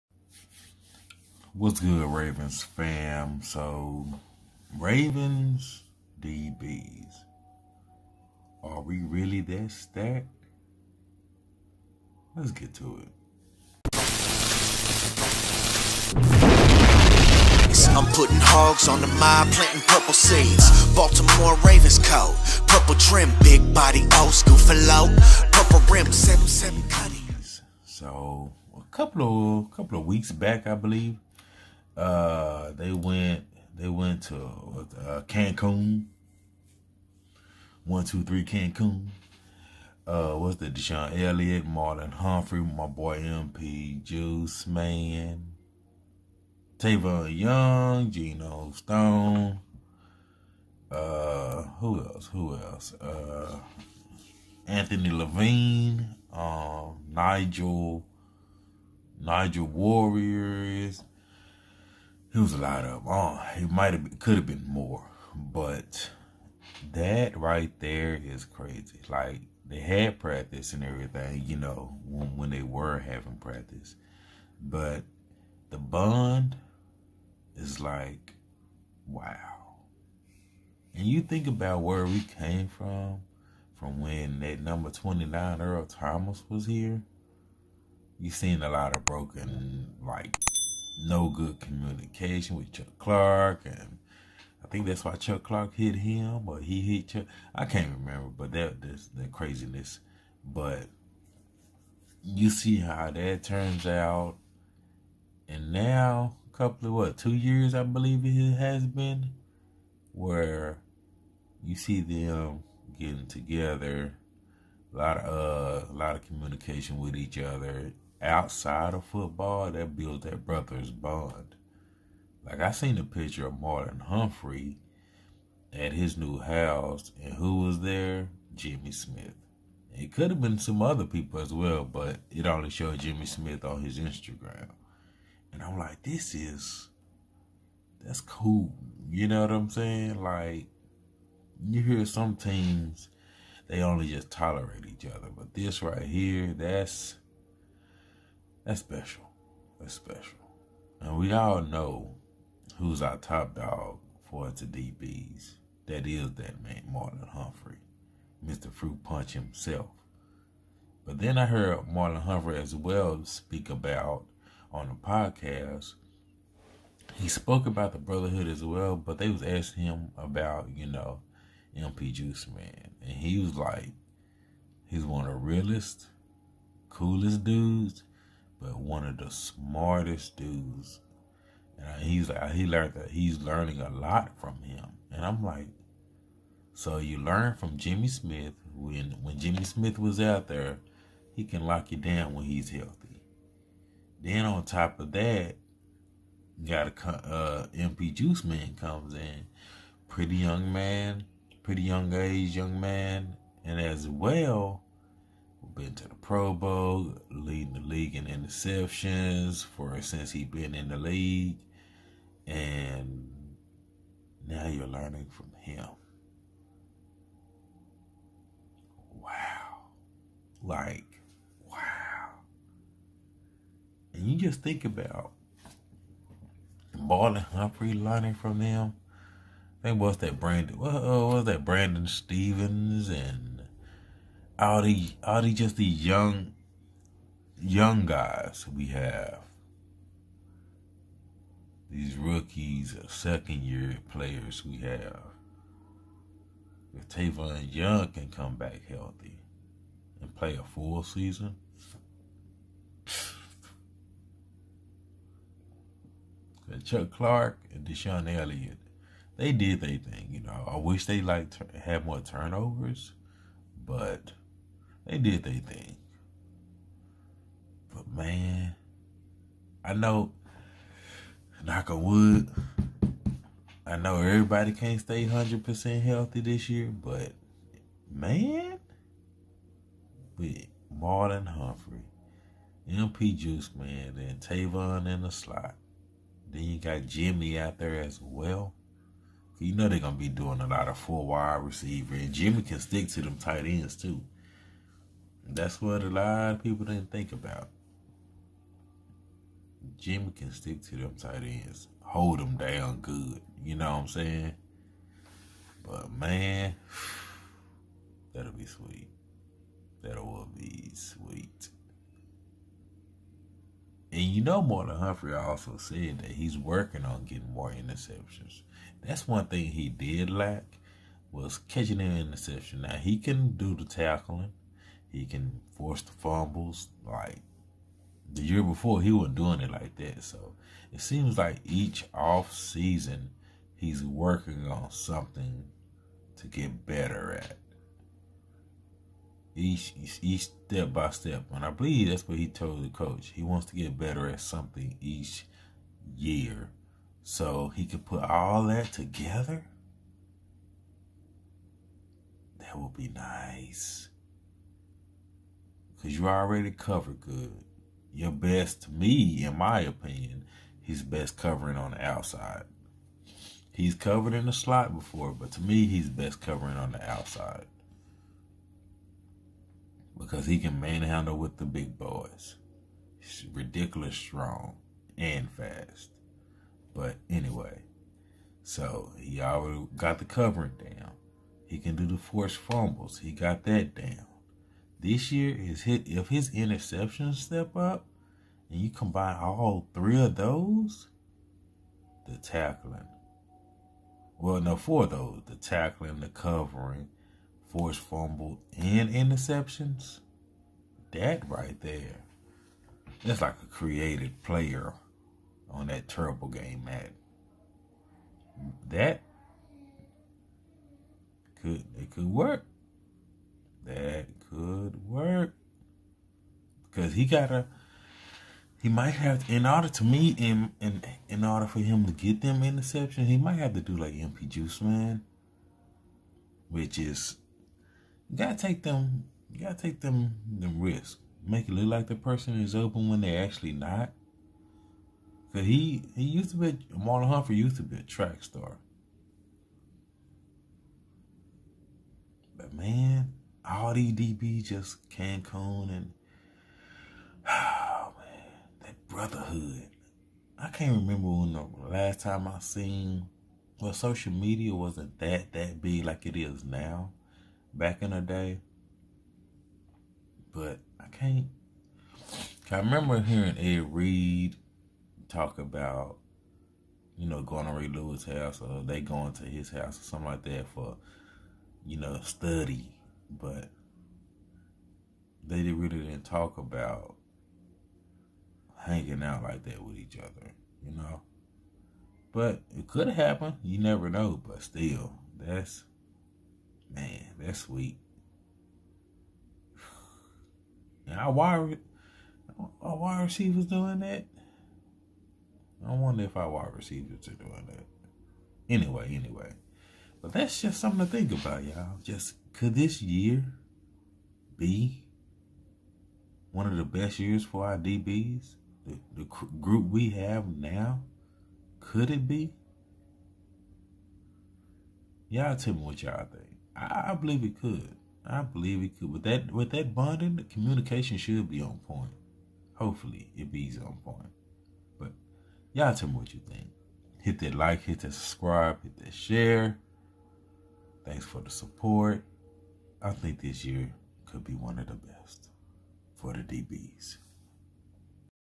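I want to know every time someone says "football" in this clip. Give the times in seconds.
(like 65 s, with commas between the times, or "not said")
119 s.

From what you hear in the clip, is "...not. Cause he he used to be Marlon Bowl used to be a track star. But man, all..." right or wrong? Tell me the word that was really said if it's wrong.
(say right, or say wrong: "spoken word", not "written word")
wrong: "Humphrey", not "Bowl".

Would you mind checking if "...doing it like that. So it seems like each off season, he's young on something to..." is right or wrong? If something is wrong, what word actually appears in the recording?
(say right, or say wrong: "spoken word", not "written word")
wrong: "working", not "young".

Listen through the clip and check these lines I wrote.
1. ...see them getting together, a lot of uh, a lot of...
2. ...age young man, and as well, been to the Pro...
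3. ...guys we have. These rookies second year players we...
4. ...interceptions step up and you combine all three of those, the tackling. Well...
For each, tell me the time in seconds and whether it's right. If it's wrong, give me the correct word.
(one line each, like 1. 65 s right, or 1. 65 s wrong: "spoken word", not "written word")
1. 111 s right
2. 202 s right
3. 238 s right
4. 386 s right.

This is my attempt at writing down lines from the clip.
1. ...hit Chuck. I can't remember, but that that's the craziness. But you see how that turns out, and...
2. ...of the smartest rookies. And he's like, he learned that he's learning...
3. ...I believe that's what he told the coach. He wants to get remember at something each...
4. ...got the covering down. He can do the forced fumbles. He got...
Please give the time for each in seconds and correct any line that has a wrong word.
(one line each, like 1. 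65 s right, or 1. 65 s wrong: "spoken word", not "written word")
1. 96 s right
2. 179 s wrong: "dudes", not "rookies"
3. 341 s wrong: "better", not "remember"
4. 379 s right.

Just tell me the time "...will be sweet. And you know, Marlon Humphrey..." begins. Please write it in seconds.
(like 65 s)
310 s.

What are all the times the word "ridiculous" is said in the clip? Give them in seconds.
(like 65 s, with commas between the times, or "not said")
373 s.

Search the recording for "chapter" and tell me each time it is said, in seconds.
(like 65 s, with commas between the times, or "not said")
not said.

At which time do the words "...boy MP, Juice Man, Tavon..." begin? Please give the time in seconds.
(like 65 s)
42 s.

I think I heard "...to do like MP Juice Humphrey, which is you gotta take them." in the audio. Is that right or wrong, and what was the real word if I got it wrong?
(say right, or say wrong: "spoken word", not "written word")
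wrong: "Man", not "Humphrey".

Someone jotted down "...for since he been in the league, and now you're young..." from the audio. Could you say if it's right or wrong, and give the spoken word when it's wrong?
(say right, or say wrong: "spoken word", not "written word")
wrong: "learning", not "young".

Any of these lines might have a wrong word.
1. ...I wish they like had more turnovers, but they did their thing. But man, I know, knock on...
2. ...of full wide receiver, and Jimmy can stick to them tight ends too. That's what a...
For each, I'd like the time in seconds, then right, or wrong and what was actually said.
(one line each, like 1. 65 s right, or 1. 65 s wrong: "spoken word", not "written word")
1. 260 s right
2. 290 s right.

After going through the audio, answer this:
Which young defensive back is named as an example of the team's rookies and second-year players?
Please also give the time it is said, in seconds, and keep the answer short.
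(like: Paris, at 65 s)
Brandon Stephens, at 231 s.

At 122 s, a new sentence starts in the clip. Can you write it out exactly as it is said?
Like I seen a picture of Marlon Humphrey at his new house, and who was there?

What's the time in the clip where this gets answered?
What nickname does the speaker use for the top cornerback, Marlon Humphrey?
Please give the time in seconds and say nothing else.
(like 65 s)
158 s.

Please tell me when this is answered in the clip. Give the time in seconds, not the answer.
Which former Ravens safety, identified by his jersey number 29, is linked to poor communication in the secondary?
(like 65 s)
85 s.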